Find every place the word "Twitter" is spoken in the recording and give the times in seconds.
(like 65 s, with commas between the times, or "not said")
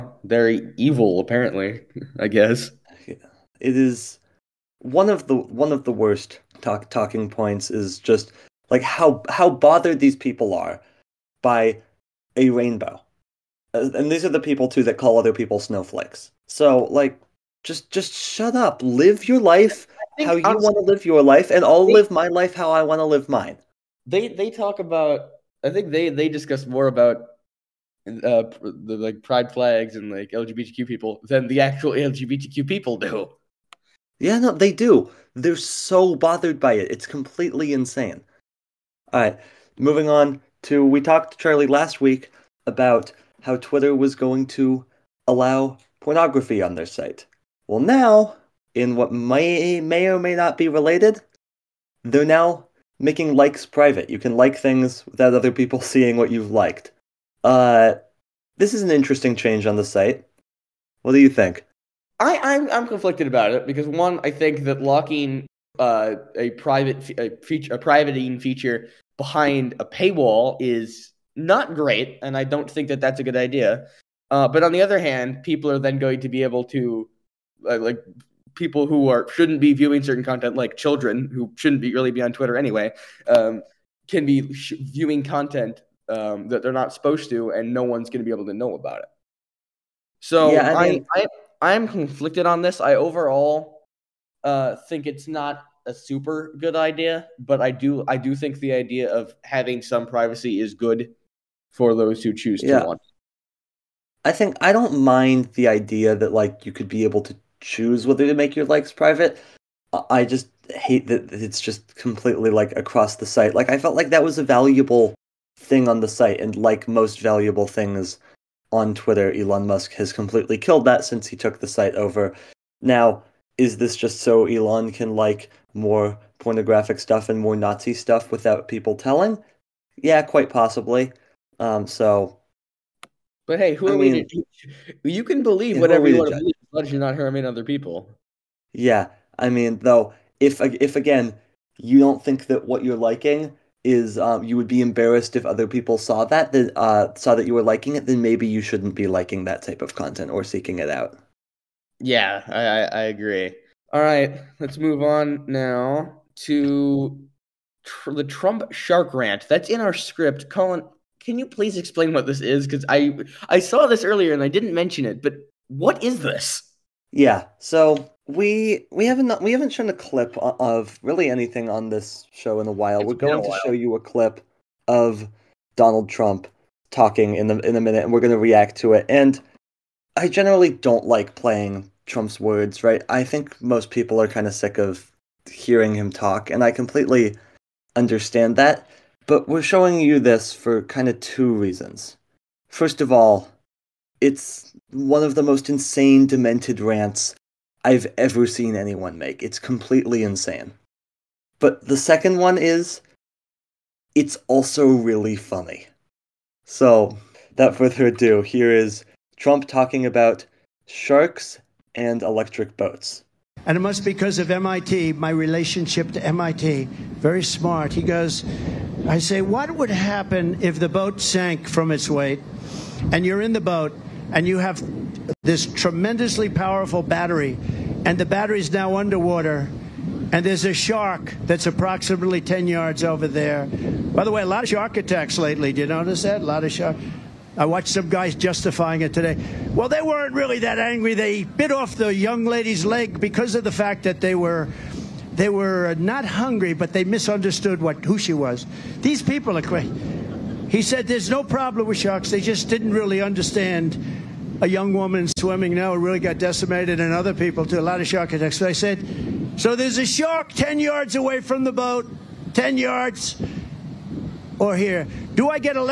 43 s, 82 s, 118 s.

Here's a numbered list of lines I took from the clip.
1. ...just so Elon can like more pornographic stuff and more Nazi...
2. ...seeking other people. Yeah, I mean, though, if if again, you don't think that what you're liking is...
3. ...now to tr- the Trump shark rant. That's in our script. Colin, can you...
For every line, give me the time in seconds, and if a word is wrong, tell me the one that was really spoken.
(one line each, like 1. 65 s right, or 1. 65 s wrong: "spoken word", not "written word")
1. 123 s right
2. 137 s wrong: "harming", not "seeking"
3. 155 s right.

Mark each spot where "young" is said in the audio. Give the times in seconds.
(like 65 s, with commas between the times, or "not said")
242 s, 254 s.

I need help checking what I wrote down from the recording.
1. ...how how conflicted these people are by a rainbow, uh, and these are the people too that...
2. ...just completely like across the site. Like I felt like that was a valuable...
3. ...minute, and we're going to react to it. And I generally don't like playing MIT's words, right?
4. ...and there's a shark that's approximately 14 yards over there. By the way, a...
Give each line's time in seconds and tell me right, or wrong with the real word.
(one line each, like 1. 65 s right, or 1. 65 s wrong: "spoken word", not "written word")
1. 8 s wrong: "bothered", not "conflicted"
2. 111 s right
3. 177 s wrong: "Trump", not "MIT"
4. 230 s wrong: "10", not "14".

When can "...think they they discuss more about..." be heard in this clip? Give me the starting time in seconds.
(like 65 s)
25 s.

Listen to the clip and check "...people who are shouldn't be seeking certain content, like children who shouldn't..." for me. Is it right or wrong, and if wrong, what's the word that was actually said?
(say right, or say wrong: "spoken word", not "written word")
wrong: "viewing", not "seeking".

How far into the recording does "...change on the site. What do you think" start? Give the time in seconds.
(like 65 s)
59 s.